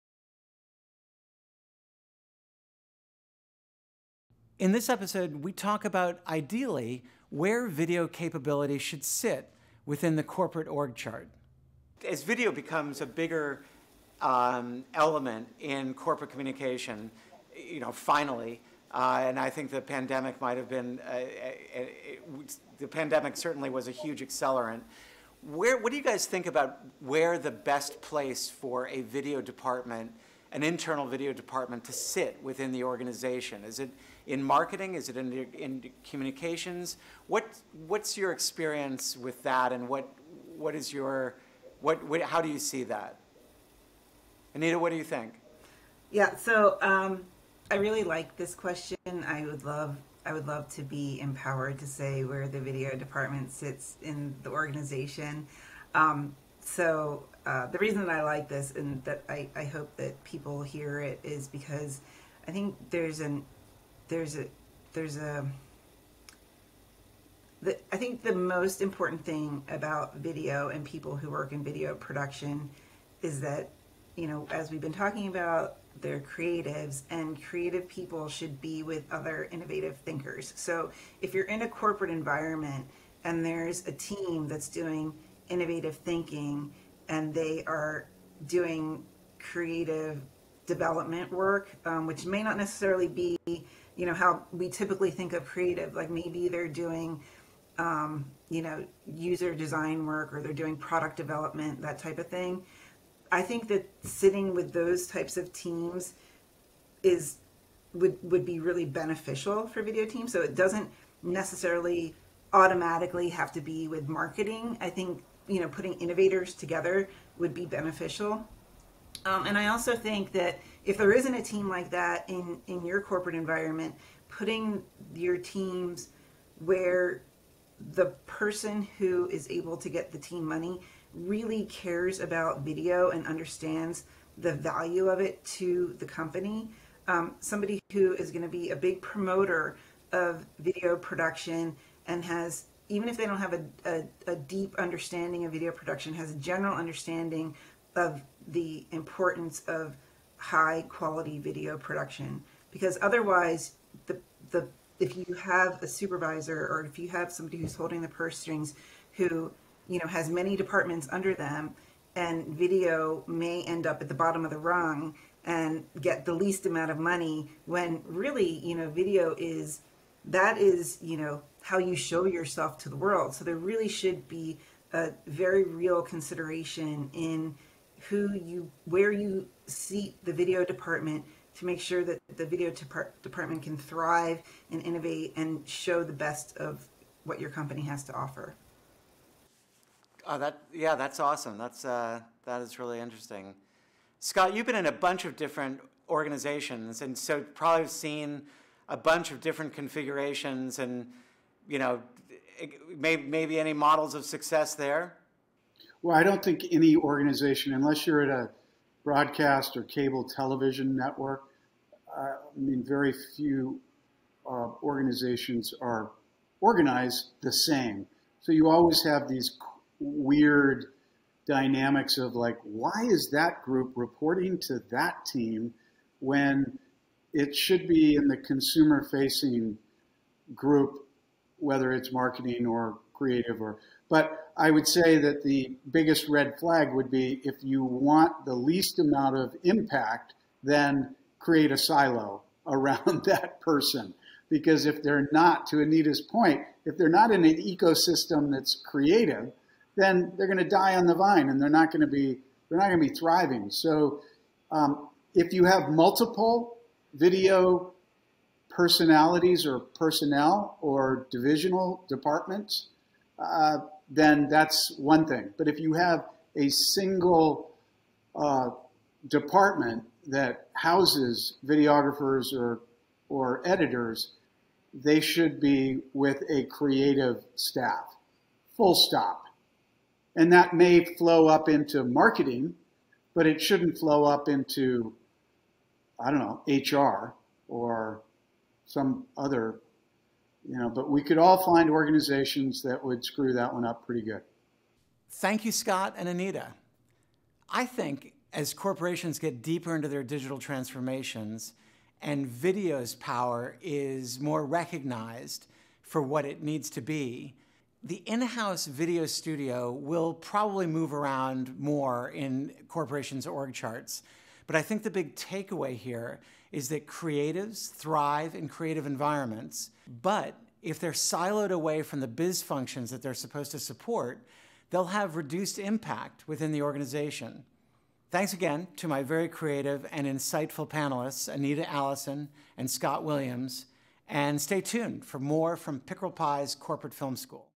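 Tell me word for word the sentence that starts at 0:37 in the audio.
What, what's your experience with that and what, what is your, what, what, how do you see that?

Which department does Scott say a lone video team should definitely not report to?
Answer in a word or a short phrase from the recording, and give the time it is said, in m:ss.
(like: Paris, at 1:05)
HR, at 4:46.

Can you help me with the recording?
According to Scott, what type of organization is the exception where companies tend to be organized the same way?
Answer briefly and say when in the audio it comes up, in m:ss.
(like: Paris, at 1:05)
Broadcast or cable television network, at 3:29.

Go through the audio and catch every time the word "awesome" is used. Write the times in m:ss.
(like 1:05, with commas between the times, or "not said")
3:11.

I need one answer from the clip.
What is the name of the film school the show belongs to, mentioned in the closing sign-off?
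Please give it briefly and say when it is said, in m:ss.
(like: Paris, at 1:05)
Pickerel Pie's Corporate Film School, at 5:35.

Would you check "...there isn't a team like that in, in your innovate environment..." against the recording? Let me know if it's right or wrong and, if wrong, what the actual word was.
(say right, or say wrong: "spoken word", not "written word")
wrong: "corporate", not "innovate".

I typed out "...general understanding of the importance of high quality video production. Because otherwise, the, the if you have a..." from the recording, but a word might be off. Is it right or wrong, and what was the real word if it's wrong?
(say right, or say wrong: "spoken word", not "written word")
right.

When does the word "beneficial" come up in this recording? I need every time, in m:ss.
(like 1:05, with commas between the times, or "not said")
1:48, 1:57.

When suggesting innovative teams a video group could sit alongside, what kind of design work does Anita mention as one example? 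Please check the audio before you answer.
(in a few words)
User design.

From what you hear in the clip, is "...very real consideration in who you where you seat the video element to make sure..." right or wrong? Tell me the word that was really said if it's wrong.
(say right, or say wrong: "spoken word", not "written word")
wrong: "department", not "element".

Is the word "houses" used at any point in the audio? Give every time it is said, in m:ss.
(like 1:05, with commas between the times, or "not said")
4:30, 5:08.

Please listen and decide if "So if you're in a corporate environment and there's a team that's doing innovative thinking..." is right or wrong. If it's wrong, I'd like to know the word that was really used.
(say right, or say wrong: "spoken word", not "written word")
right.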